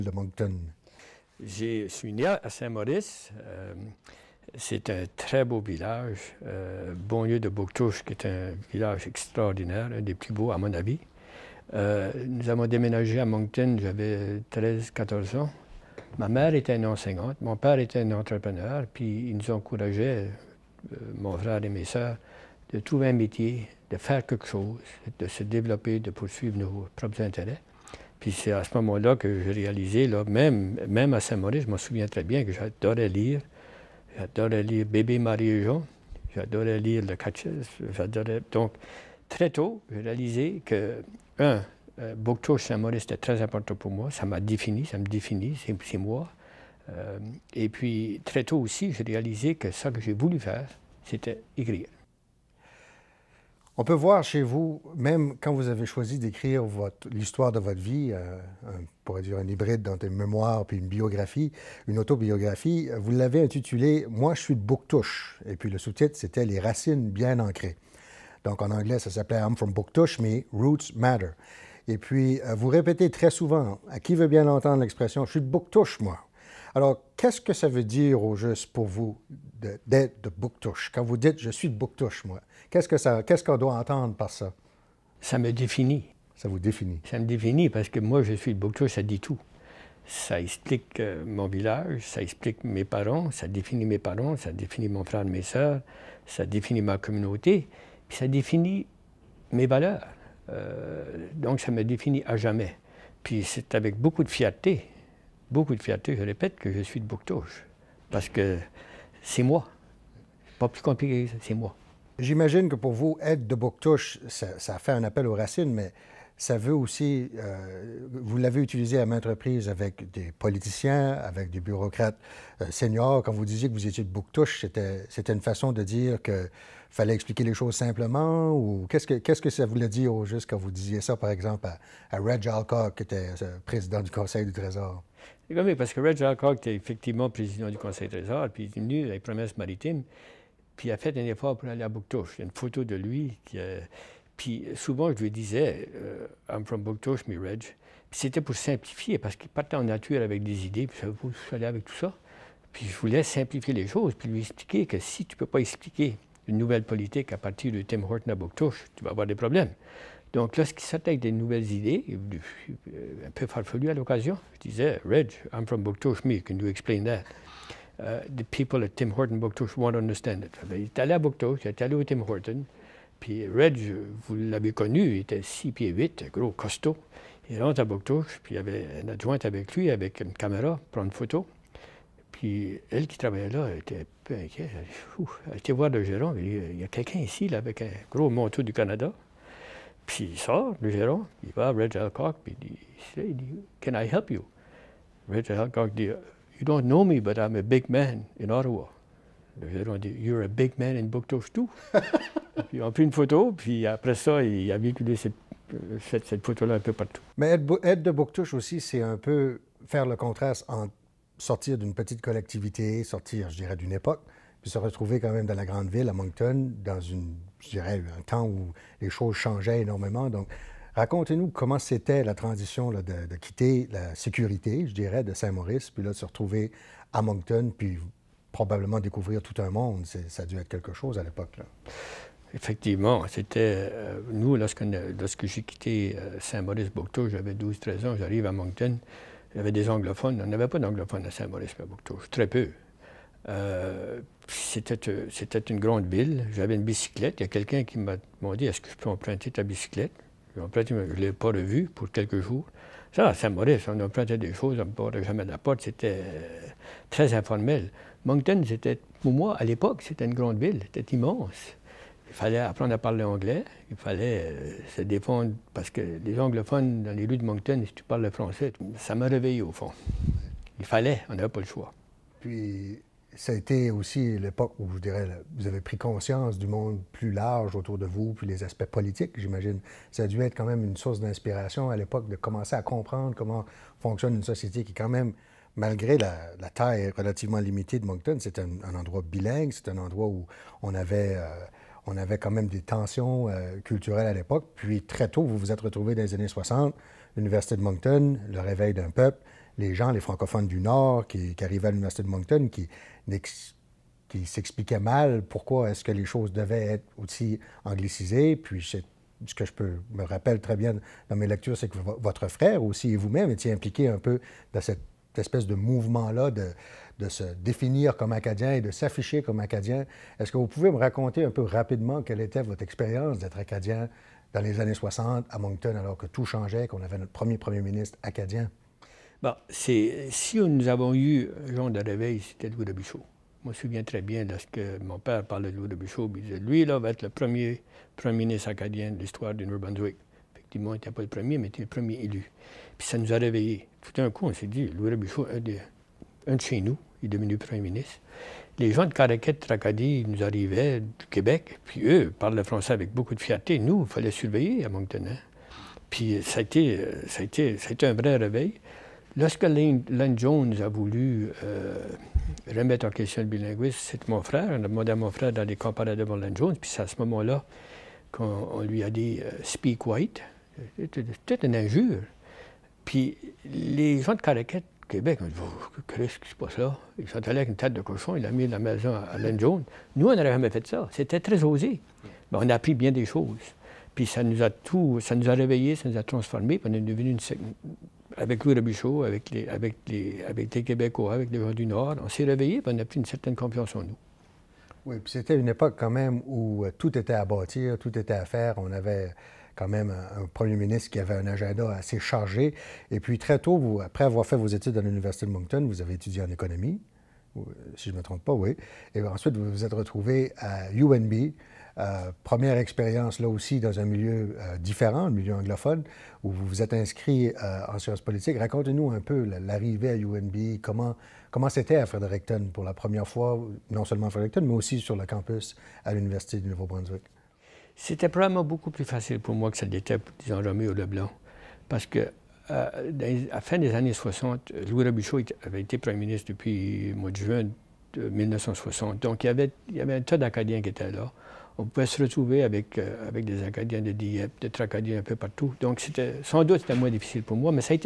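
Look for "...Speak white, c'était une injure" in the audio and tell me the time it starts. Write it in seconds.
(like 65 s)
369 s.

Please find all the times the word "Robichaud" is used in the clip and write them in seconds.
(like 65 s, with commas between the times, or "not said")
388 s, 435 s.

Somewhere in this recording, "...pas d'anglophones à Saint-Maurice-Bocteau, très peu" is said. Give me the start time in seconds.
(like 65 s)
240 s.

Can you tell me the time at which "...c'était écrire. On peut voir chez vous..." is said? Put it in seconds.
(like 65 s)
51 s.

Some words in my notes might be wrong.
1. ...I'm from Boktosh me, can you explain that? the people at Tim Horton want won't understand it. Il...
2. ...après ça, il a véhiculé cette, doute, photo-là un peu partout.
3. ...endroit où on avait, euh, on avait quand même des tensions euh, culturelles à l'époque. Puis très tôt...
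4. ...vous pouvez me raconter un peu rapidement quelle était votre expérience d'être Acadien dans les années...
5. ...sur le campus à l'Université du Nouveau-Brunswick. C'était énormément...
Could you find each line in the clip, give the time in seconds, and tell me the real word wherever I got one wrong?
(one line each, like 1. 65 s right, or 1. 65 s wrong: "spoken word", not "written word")
1. 165 s right
2. 203 s wrong: "cette", not "doute"
3. 289 s right
4. 320 s right
5. 424 s wrong: "probablement", not "énormément".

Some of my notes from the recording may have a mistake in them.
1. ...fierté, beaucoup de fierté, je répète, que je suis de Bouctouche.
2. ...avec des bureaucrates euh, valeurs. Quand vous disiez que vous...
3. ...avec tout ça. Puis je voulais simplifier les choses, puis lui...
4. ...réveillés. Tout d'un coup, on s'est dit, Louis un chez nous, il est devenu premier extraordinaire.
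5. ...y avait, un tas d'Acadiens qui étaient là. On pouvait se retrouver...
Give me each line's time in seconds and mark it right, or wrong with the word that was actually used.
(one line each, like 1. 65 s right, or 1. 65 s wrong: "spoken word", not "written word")
1. 104 s right
2. 121 s wrong: "seniors", not "valeurs"
3. 151 s right
4. 343 s wrong: "ministre", not "extraordinaire"
5. 439 s right.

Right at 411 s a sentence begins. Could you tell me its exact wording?
Euh, première expérience là aussi dans un milieu euh, différent, le milieu anglophone, où vous vous êtes inscrit en sciences politiques.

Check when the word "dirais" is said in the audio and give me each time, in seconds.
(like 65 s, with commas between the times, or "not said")
213 s, 217 s, 224 s, 274 s.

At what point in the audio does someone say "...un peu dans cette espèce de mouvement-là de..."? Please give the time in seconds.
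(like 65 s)
314 s.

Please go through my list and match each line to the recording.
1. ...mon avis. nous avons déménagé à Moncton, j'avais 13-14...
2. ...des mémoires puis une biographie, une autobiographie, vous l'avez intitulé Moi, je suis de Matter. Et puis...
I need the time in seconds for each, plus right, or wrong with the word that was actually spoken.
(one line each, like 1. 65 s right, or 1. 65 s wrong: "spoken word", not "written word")
1. 10 s right
2. 59 s wrong: "Bouctouche", not "Matter".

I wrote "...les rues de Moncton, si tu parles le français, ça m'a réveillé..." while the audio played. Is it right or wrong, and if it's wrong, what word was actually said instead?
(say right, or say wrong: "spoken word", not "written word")
right.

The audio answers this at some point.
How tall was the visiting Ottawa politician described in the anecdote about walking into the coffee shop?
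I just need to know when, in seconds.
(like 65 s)
175 s.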